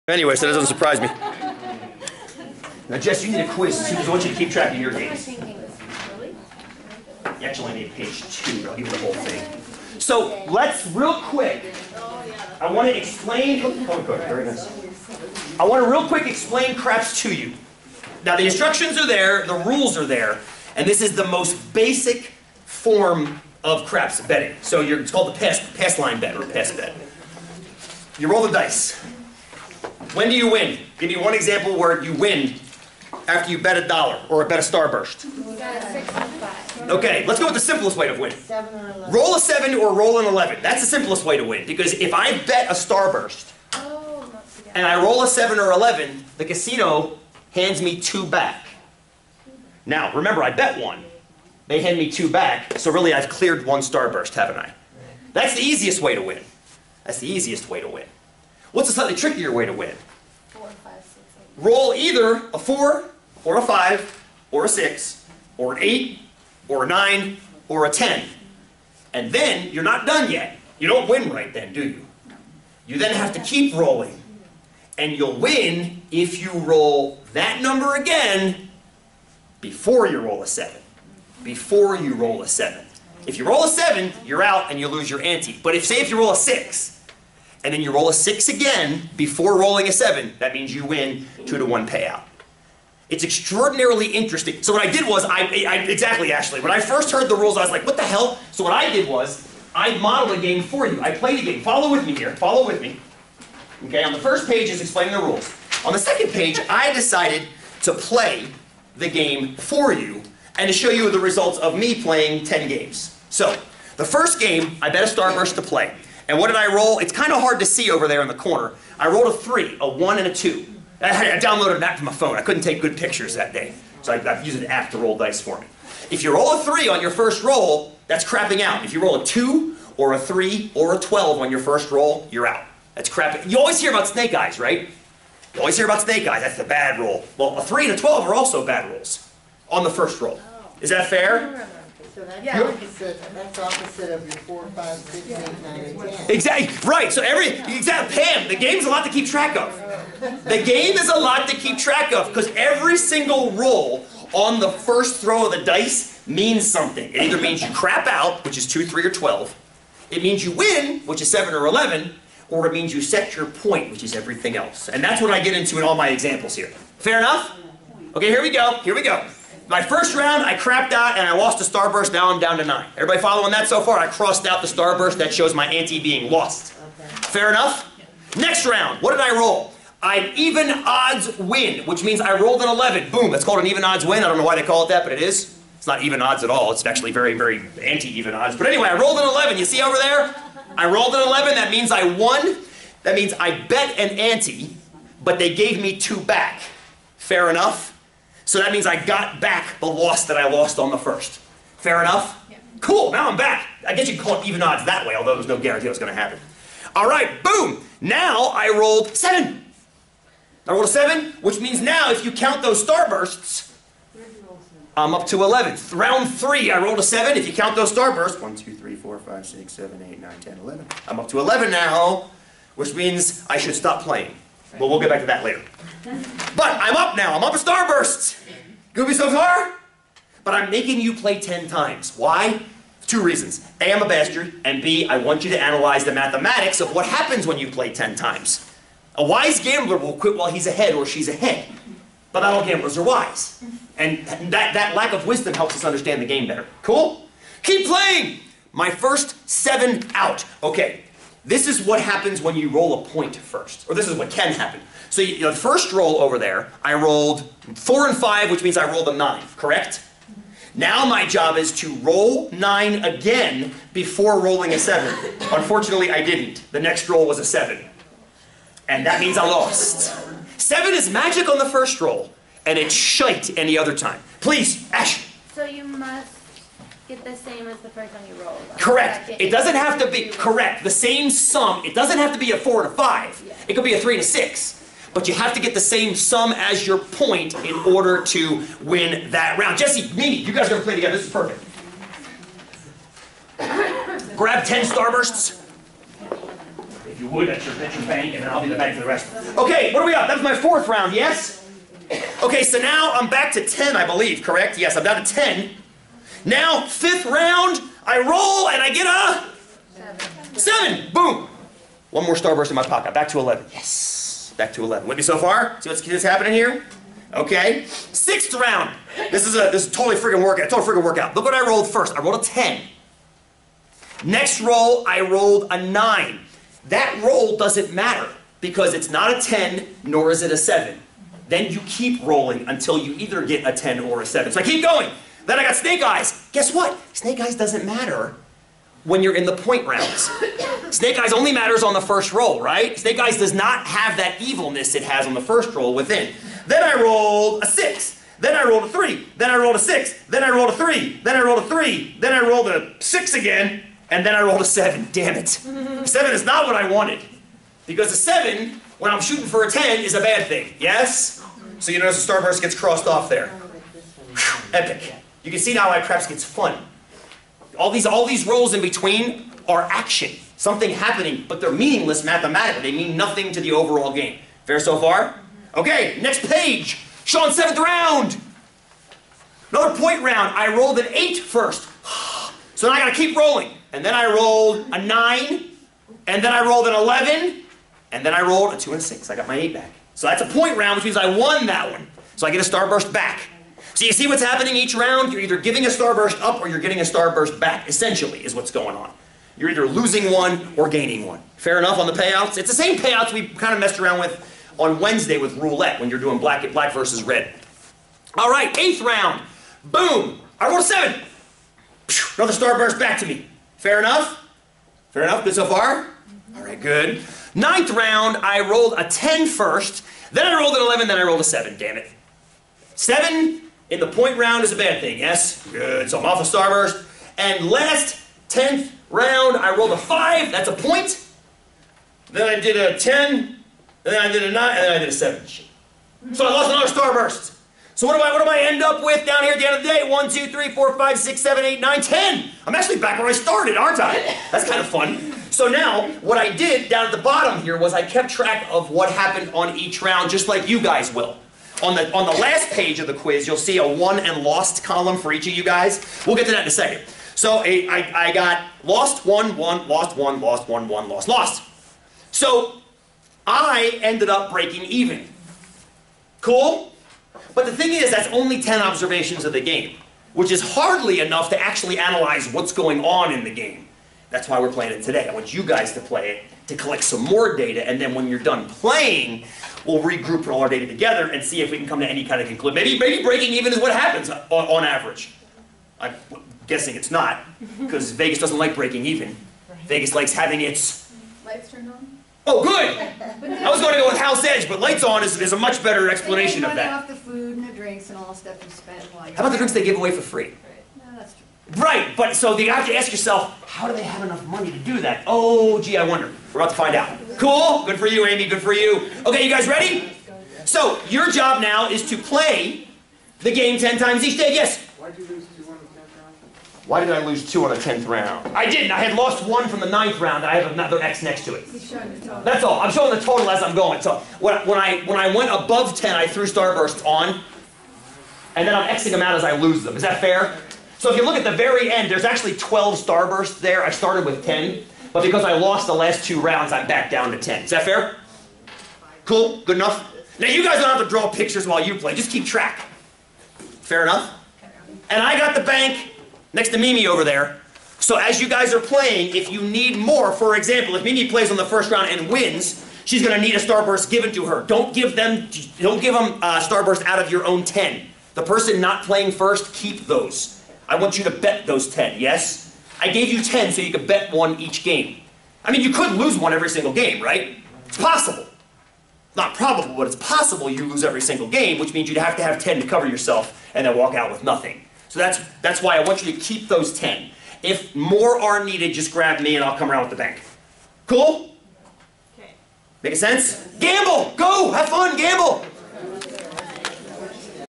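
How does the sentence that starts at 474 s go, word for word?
That's why we're playing it today.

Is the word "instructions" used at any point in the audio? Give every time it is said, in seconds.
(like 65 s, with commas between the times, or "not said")
18 s.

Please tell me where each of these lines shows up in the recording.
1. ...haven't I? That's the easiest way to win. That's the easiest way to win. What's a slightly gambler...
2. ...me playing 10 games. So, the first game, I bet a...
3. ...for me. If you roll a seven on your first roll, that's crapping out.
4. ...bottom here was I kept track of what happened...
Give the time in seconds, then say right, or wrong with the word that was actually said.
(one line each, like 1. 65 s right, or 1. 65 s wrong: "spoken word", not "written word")
1. 54 s wrong: "trickier", not "gambler"
2. 111 s right
3. 125 s wrong: "three", not "seven"
4. 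447 s right.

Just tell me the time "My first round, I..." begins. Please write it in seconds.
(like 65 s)
169 s.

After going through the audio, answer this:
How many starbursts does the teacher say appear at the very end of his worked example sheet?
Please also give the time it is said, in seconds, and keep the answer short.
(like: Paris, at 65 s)
12, at 532 s.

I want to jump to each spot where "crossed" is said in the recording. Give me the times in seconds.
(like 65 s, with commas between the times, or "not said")
174 s, 362 s.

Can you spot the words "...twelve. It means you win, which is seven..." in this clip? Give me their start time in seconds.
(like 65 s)
159 s.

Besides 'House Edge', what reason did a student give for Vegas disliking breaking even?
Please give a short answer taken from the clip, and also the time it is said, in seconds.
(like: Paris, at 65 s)
Lights turned on, at 491 s.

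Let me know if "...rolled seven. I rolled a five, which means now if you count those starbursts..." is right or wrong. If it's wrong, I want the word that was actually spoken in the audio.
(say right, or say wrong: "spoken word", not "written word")
wrong: "seven", not "five".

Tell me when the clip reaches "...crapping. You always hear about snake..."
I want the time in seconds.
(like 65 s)
133 s.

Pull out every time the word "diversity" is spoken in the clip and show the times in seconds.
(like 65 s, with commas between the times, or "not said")
not said.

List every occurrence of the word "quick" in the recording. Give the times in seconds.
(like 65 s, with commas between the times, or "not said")
11 s, 16 s.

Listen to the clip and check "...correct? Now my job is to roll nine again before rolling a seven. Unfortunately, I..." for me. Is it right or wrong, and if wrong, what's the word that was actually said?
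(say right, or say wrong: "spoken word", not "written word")
right.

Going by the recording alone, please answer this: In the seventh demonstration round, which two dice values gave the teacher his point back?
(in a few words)
2 and 6.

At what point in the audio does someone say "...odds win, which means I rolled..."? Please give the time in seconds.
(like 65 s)
180 s.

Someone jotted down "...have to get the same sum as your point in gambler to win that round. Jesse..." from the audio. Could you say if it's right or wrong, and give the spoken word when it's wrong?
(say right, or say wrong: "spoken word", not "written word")
wrong: "order", not "gambler".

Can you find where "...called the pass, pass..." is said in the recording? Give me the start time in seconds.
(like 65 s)
25 s.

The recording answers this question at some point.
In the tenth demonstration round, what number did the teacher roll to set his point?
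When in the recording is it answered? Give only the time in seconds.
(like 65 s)
429 s.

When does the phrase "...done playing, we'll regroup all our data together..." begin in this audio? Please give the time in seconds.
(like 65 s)
478 s.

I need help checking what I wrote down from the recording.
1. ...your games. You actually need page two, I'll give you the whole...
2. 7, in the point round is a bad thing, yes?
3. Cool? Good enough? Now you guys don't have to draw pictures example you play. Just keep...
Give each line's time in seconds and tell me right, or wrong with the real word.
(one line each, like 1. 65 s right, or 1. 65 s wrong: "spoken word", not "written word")
1. 4 s right
2. 422 s right
3. 539 s wrong: "while", not "example".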